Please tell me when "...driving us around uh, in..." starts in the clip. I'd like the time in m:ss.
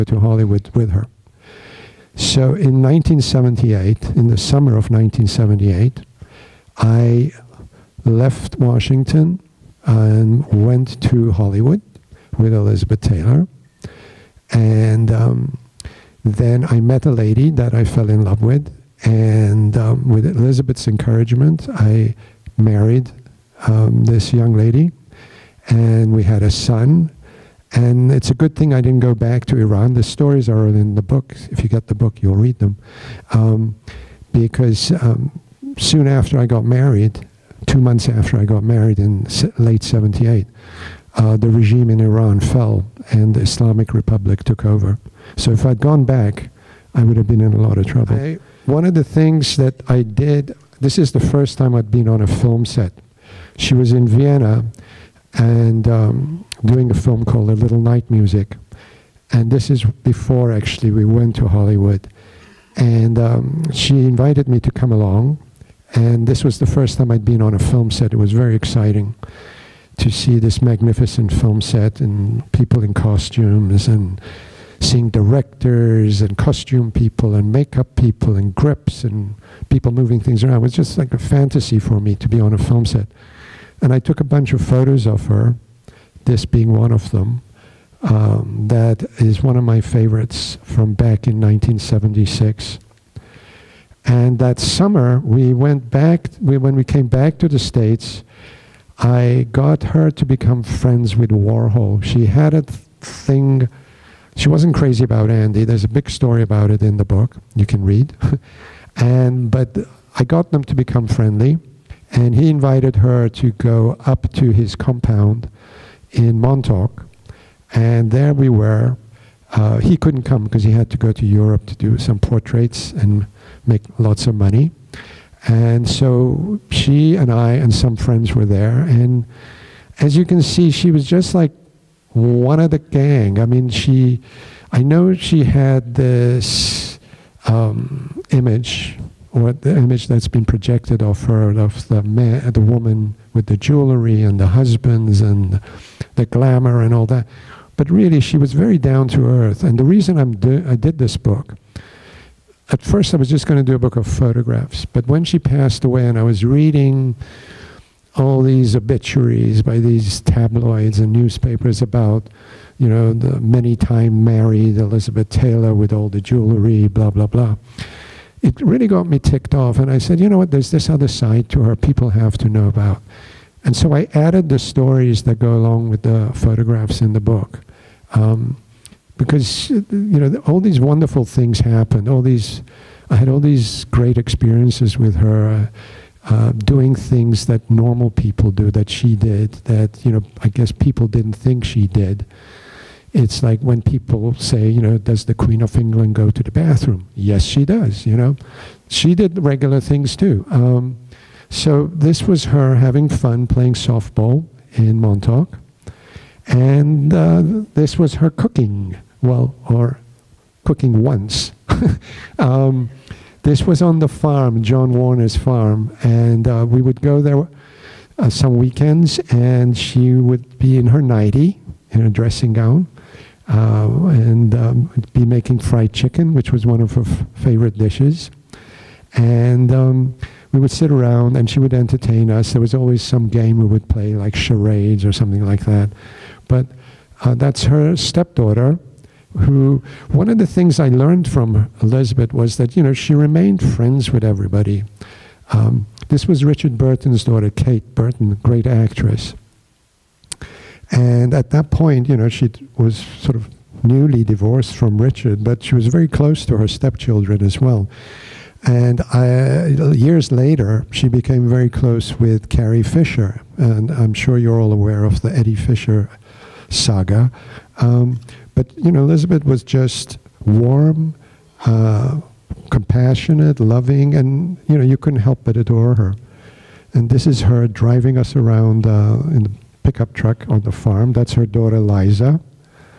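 4:37.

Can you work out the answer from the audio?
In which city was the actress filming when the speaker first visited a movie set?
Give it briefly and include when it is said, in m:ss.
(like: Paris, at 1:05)
Vienna, at 0:54.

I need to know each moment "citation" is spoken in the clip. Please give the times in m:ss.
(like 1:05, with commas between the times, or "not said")
not said.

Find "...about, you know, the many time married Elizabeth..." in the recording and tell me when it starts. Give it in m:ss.
2:41.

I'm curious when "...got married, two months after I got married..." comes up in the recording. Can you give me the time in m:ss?
0:36.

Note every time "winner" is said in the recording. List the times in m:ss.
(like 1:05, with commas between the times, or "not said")
not said.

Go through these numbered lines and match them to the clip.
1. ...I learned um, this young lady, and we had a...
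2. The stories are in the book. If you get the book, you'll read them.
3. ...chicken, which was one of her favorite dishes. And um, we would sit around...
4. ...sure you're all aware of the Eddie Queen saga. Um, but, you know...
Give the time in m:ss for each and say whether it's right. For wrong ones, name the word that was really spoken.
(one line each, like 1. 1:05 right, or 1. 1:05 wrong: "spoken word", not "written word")
1. 0:21 wrong: "married", not "learned"
2. 0:29 right
3. 3:45 right
4. 4:24 wrong: "Fisher", not "Queen".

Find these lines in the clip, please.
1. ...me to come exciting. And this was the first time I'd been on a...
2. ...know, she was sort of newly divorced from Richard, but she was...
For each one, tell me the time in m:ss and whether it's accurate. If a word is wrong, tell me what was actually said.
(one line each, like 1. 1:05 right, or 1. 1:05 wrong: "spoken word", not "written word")
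1. 1:04 wrong: "along", not "exciting"
2. 4:12 right.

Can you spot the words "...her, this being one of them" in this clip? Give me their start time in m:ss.
1:25.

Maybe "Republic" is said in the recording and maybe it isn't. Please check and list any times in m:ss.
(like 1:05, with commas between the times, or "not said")
0:43.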